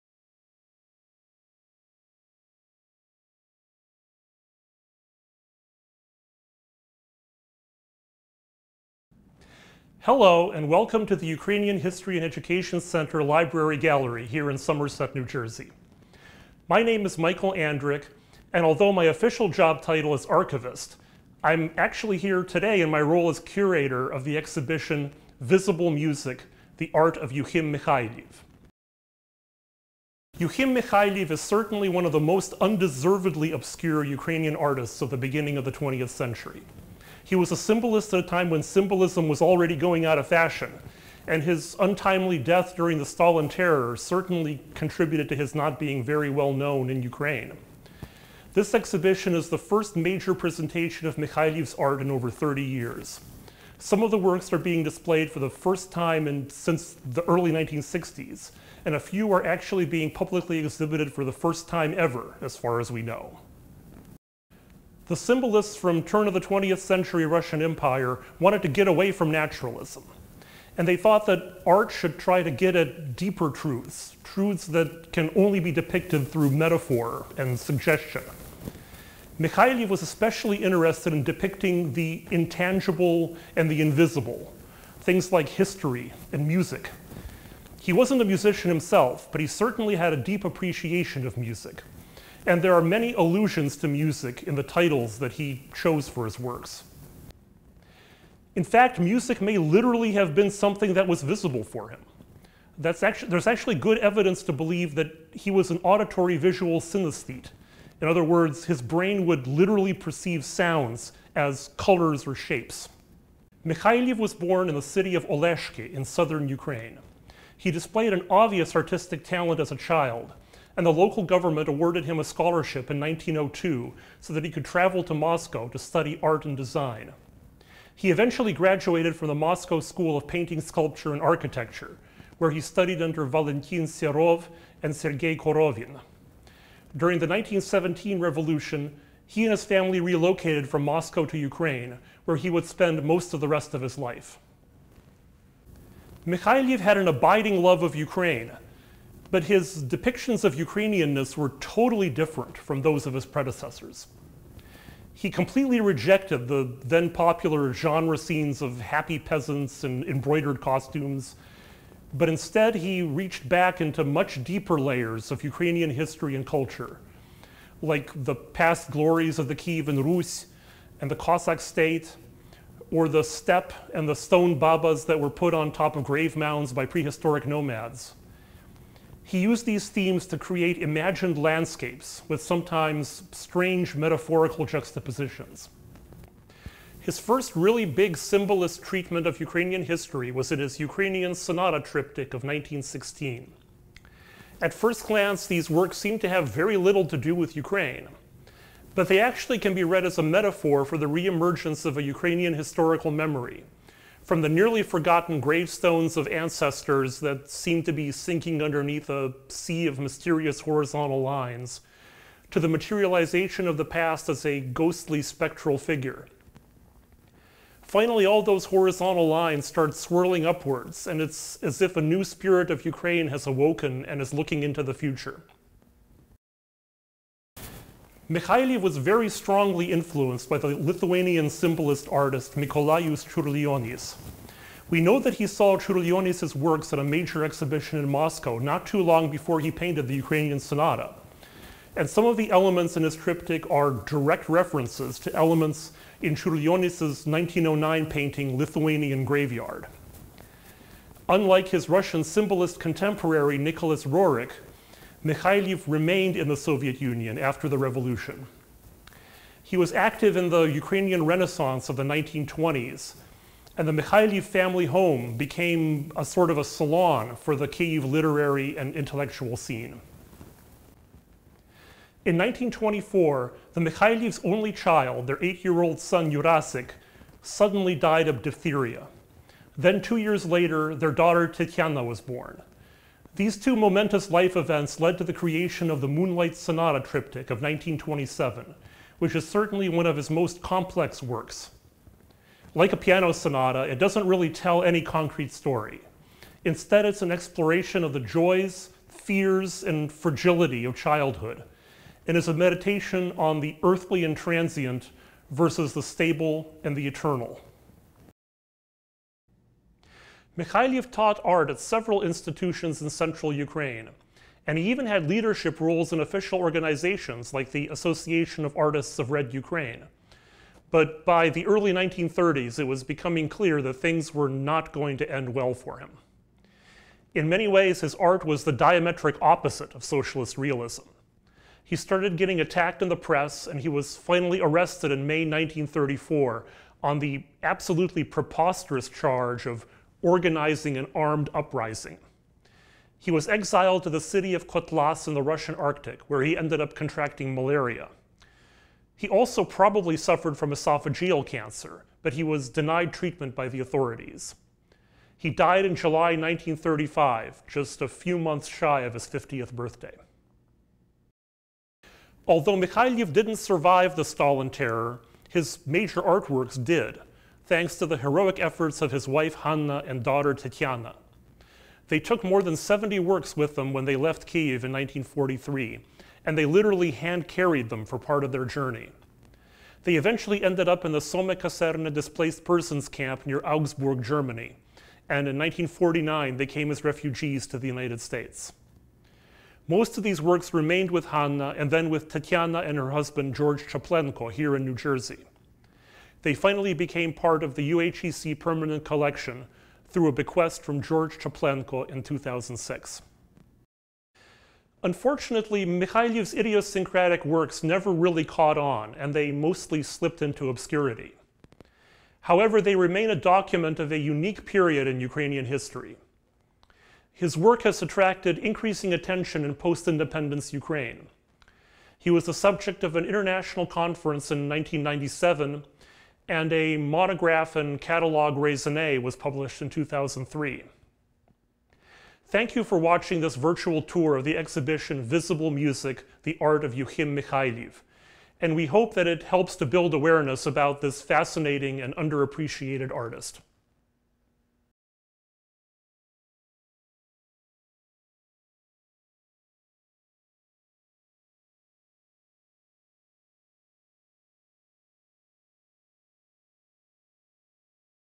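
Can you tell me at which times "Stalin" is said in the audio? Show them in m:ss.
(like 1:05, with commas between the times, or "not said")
0:43, 6:04.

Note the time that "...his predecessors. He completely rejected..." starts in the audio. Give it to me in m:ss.
2:33.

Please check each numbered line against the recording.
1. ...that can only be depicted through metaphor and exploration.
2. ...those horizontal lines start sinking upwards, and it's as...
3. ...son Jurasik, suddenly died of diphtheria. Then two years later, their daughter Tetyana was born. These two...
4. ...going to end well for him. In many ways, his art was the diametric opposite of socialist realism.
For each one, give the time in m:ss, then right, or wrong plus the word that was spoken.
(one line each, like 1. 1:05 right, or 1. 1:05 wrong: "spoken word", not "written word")
1. 1:14 wrong: "suggestion", not "exploration"
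2. 3:38 wrong: "swirling", not "sinking"
3. 4:35 right
4. 5:24 right.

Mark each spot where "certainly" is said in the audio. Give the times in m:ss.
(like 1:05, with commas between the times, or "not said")
0:31, 0:43, 1:29, 4:49.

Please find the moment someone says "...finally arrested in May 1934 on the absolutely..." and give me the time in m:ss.
5:34.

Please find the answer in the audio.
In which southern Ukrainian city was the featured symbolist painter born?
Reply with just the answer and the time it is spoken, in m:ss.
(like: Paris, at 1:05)
Oleshki, at 1:55.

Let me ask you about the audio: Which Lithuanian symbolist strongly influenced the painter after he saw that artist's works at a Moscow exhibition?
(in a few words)
Mikalojus Čiurlionis.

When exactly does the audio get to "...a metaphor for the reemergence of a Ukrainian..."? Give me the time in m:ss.
3:20.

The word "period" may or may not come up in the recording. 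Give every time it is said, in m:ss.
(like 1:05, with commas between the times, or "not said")
6:54.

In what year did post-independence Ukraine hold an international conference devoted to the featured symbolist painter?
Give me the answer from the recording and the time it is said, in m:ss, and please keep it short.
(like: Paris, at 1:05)
1997, at 7:04.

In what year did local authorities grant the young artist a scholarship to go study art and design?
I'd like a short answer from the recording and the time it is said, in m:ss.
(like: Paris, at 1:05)
1902, at 2:02.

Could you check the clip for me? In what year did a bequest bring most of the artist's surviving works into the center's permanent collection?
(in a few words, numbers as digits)
2006.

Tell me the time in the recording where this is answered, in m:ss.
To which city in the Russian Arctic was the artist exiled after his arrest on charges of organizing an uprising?
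5:44.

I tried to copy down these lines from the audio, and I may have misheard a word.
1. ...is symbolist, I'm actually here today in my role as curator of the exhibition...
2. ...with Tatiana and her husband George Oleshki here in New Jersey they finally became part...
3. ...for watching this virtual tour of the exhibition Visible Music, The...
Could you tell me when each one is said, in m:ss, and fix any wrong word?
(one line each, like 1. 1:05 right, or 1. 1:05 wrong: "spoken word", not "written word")
1. 0:20 wrong: "archivist", not "symbolist"
2. 6:32 wrong: "Chaplenko", not "Oleshki"
3. 7:12 right.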